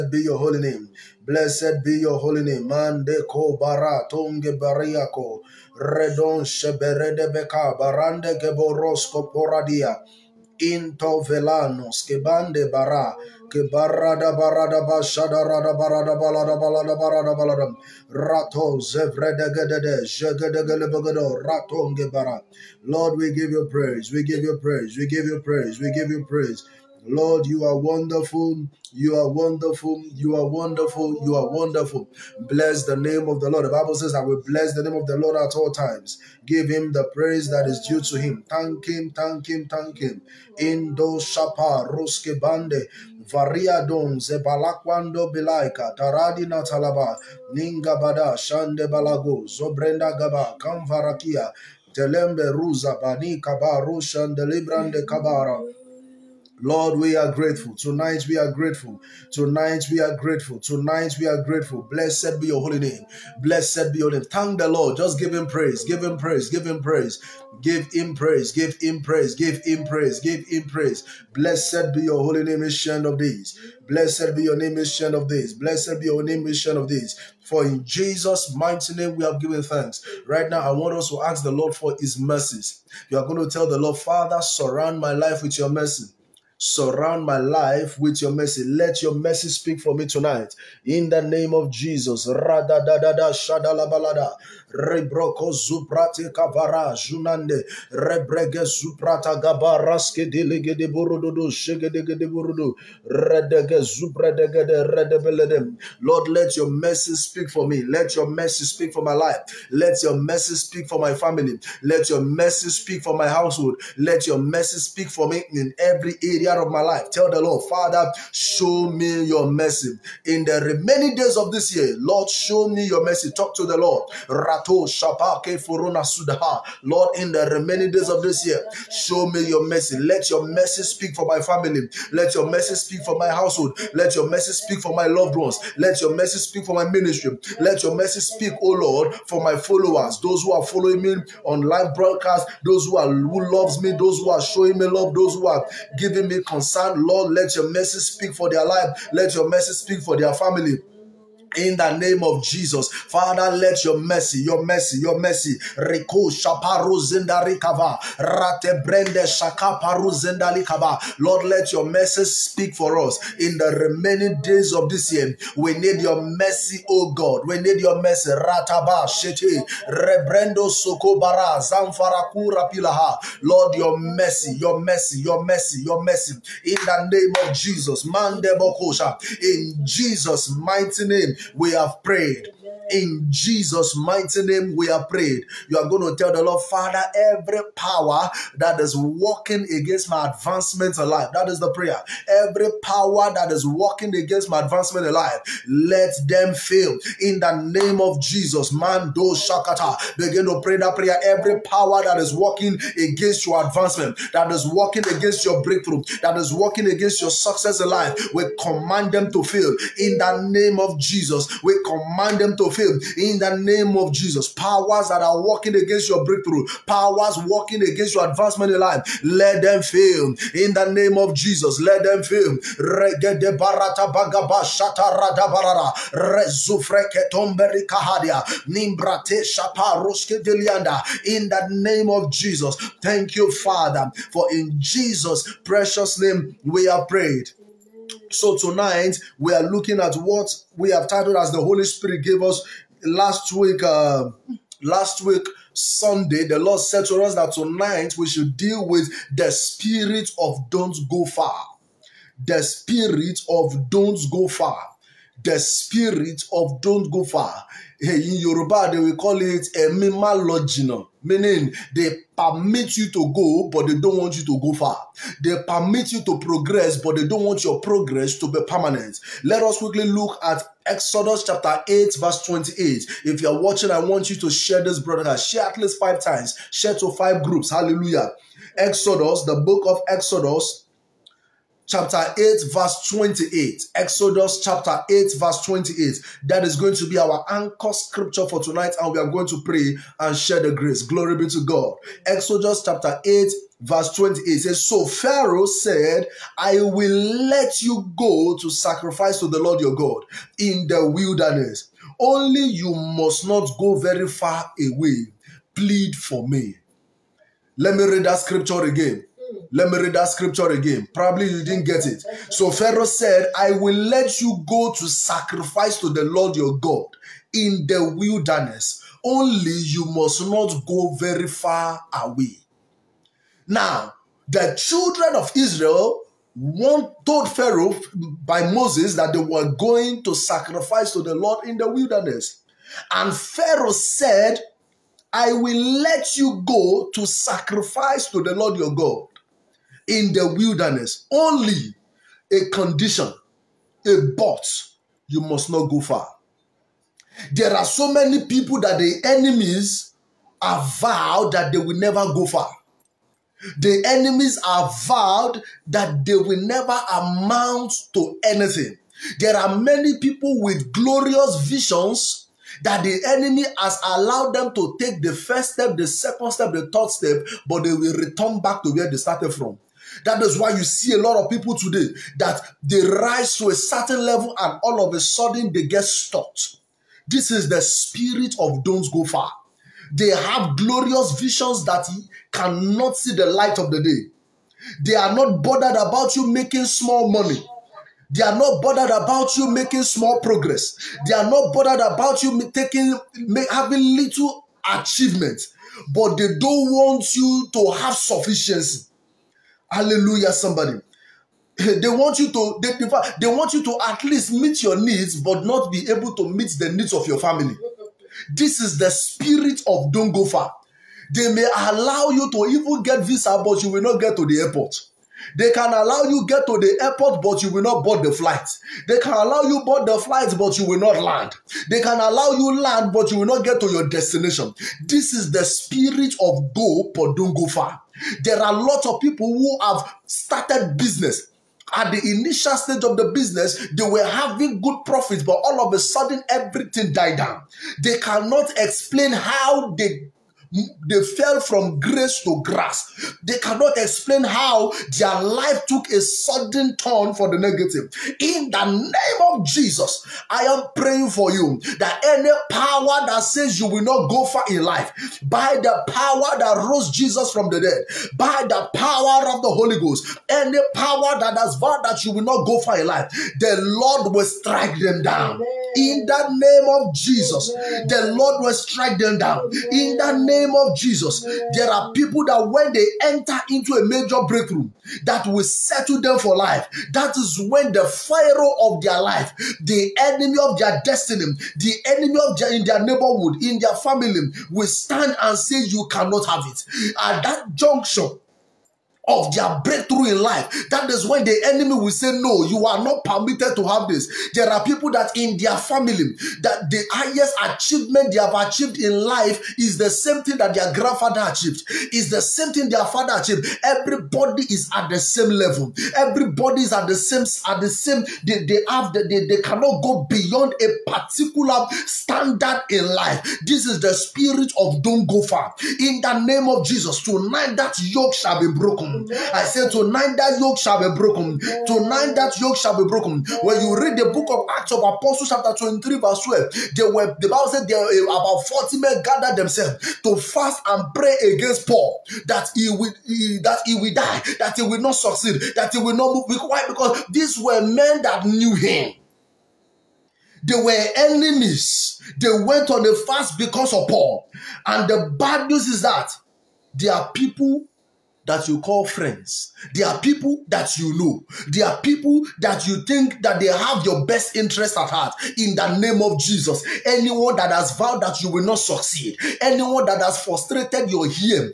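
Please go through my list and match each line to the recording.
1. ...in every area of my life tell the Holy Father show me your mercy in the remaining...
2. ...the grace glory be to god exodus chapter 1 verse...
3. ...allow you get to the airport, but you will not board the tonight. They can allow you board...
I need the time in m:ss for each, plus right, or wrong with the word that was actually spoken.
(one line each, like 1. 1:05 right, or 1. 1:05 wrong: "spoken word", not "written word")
1. 1:55 wrong: "Lord", not "Holy"
2. 4:50 wrong: "8", not "1"
3. 6:55 wrong: "flight", not "tonight".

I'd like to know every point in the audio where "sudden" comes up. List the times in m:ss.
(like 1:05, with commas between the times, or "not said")
6:15, 7:15, 7:26.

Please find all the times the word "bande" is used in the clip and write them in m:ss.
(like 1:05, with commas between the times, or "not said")
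0:12, 0:42.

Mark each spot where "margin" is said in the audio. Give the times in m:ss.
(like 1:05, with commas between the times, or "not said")
not said.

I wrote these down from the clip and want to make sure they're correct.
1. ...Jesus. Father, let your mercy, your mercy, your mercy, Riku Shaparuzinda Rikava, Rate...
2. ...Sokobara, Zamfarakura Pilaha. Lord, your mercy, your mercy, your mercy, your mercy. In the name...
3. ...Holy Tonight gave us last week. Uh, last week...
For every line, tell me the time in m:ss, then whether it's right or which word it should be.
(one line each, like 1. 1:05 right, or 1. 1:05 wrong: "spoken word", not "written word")
1. 2:32 right
2. 2:50 right
3. 4:01 wrong: "Spirit", not "Tonight".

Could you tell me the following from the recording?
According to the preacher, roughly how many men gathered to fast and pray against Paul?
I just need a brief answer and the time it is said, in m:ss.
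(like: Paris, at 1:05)
40, at 8:48.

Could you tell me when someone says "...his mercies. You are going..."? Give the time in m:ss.
1:21.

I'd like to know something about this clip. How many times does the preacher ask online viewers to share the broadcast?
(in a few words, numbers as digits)
5 times.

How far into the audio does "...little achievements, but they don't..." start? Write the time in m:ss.
6:34.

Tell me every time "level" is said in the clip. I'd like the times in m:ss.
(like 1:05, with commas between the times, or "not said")
6:14, 8:25.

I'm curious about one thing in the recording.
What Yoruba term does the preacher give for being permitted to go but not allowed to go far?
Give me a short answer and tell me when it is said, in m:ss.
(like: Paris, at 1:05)
a mimalogina, at 4:19.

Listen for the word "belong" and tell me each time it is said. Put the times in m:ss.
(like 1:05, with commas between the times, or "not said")
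not said.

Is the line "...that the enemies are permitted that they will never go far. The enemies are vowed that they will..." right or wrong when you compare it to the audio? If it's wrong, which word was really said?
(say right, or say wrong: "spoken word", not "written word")
wrong: "vowed", not "permitted".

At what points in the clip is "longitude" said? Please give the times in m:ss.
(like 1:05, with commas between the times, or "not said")
not said.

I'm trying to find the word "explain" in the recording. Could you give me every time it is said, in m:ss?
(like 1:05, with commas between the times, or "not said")
7:18, 7:23.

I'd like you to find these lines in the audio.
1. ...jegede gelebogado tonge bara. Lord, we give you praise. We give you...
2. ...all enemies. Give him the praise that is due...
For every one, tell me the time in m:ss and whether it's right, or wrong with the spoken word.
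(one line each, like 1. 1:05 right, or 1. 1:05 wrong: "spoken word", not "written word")
1. 0:20 wrong: "ratonge", not "tonge"
2. 0:35 wrong: "times", not "enemies".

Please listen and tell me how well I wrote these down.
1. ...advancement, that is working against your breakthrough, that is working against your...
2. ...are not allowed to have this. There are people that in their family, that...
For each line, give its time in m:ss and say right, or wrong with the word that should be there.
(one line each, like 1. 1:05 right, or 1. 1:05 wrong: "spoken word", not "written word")
1. 3:23 right
2. 8:12 wrong: "permitted", not "allowed".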